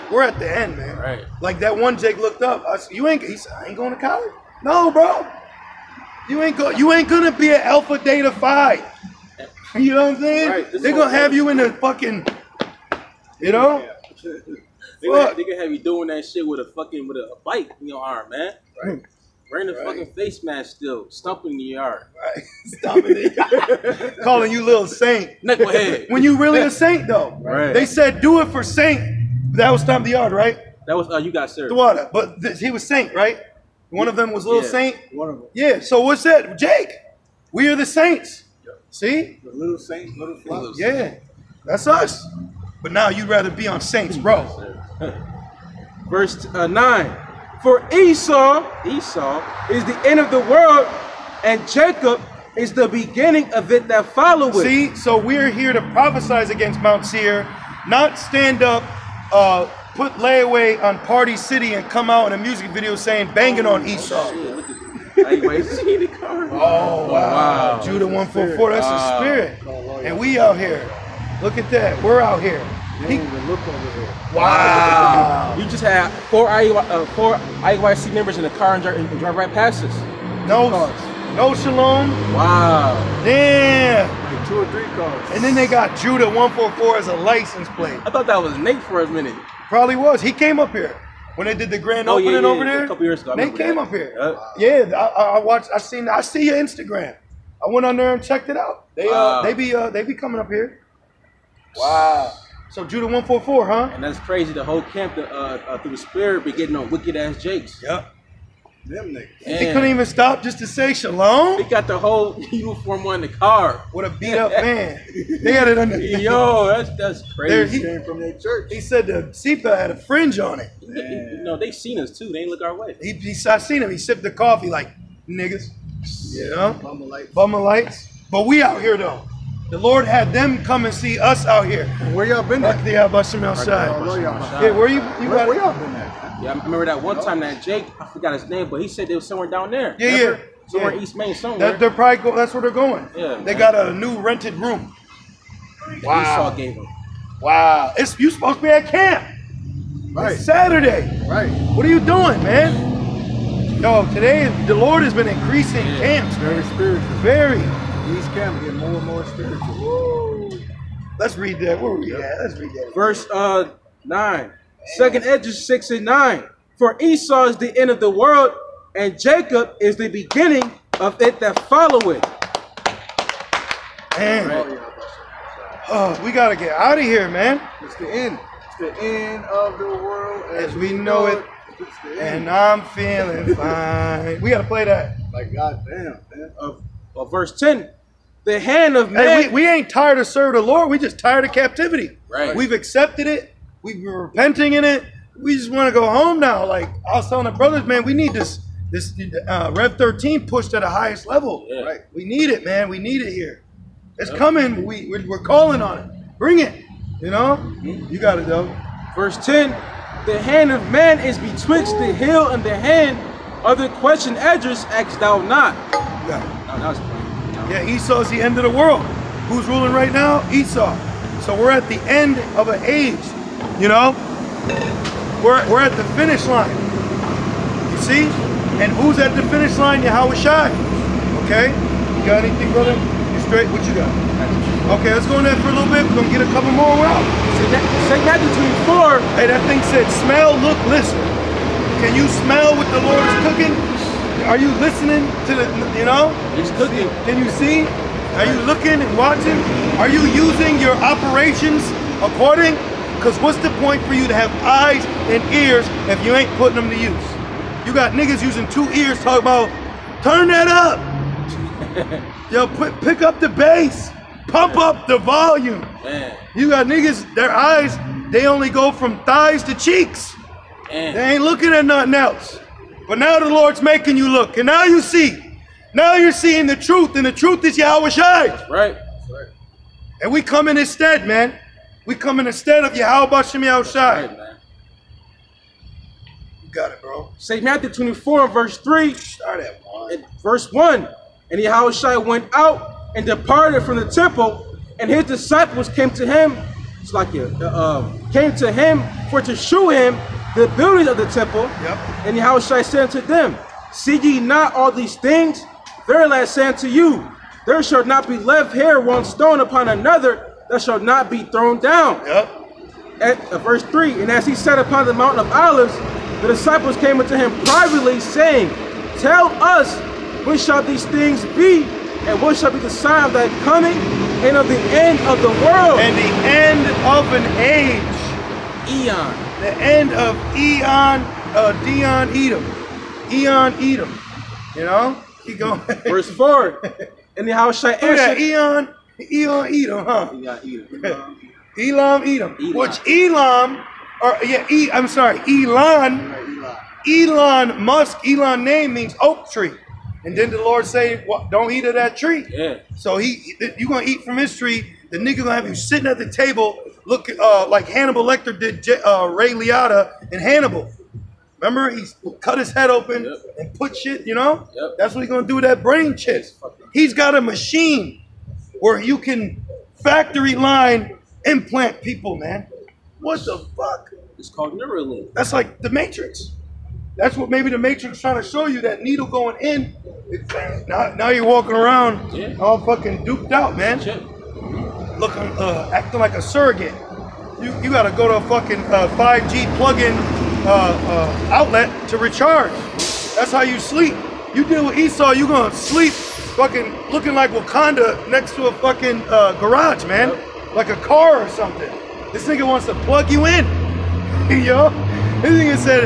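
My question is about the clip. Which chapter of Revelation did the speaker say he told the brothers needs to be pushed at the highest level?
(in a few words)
Rev 13.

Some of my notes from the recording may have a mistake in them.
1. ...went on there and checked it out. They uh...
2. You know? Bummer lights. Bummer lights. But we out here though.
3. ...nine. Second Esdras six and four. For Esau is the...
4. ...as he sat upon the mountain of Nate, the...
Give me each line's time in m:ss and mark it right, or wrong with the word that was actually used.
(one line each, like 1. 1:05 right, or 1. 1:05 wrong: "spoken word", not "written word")
1. 1:37 right
2. 2:06 right
3. 2:44 wrong: "nine", not "four"
4. 5:14 wrong: "Olives", not "Nate".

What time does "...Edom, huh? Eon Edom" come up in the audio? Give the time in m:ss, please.
5:39.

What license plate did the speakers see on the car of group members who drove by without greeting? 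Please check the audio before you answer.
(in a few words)
Judah 144.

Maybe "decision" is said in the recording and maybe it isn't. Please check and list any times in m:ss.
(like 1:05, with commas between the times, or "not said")
not said.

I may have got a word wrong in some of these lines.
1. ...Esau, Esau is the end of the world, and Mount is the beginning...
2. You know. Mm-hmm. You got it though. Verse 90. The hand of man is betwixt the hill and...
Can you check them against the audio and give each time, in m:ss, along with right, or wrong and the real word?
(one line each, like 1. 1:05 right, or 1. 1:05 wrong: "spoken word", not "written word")
1. 0:47 wrong: "Jacob", not "Mount"
2. 3:27 wrong: "10", not "90".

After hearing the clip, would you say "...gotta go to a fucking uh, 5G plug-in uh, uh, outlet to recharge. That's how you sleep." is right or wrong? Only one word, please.
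right.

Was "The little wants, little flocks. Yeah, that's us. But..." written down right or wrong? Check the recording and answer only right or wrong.
wrong.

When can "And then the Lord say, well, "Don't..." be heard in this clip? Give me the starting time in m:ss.
5:50.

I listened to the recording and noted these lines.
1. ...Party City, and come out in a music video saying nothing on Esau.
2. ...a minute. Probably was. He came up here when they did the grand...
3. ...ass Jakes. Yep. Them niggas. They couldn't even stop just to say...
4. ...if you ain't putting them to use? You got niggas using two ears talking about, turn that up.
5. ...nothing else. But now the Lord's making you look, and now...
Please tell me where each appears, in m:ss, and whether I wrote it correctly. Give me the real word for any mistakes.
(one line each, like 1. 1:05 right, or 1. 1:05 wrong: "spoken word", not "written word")
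1. 1:01 wrong: "banging", not "nothing"
2. 1:29 right
3. 1:47 right
4. 4:16 right
5. 4:31 right.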